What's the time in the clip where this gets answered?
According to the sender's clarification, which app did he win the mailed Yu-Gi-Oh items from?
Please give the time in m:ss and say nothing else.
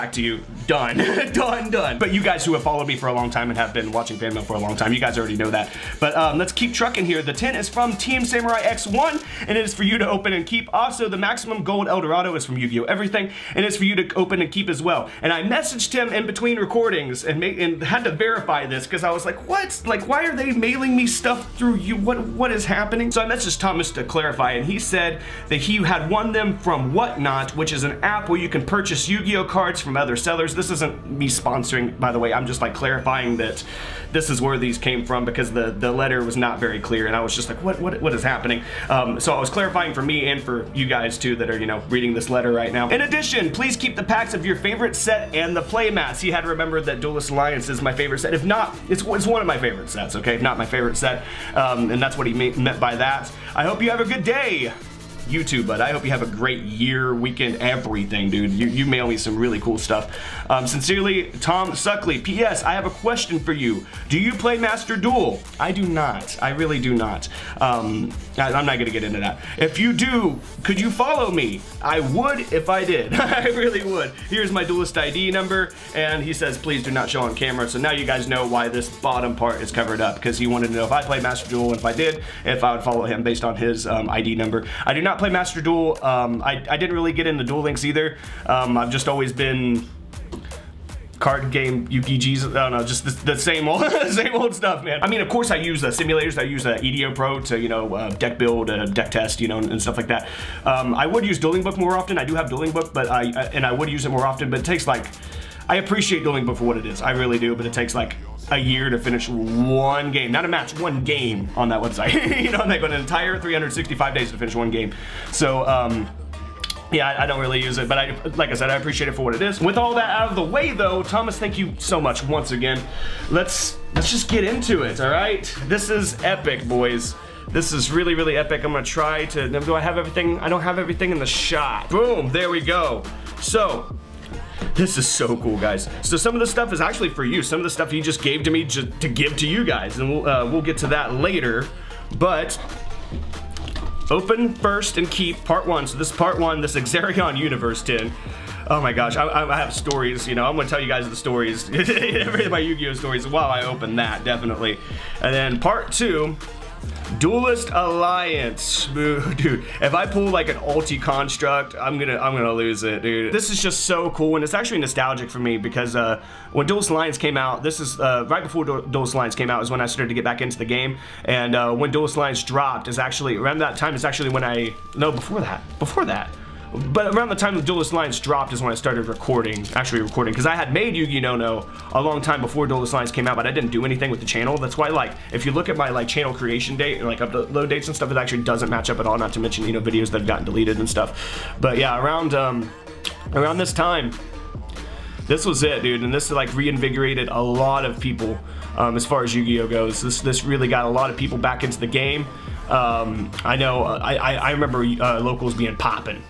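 0:26.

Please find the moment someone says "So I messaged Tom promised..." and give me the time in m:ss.
0:23.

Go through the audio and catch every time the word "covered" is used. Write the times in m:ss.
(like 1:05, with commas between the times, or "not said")
1:19.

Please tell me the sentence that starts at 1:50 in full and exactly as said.
Not a match, one game on that website.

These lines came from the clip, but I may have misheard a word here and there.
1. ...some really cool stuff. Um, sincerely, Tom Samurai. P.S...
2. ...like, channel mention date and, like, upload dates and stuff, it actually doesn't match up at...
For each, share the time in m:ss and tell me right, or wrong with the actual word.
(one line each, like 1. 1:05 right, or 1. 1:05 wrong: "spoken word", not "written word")
1. 0:59 wrong: "Suckley", not "Samurai"
2. 3:05 wrong: "creation", not "mention".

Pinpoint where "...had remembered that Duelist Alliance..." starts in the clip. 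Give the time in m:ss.
0:46.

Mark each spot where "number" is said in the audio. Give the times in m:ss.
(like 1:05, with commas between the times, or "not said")
1:15, 1:24.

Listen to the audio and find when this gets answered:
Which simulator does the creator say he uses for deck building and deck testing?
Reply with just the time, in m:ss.
1:36.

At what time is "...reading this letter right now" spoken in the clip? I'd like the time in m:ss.
0:41.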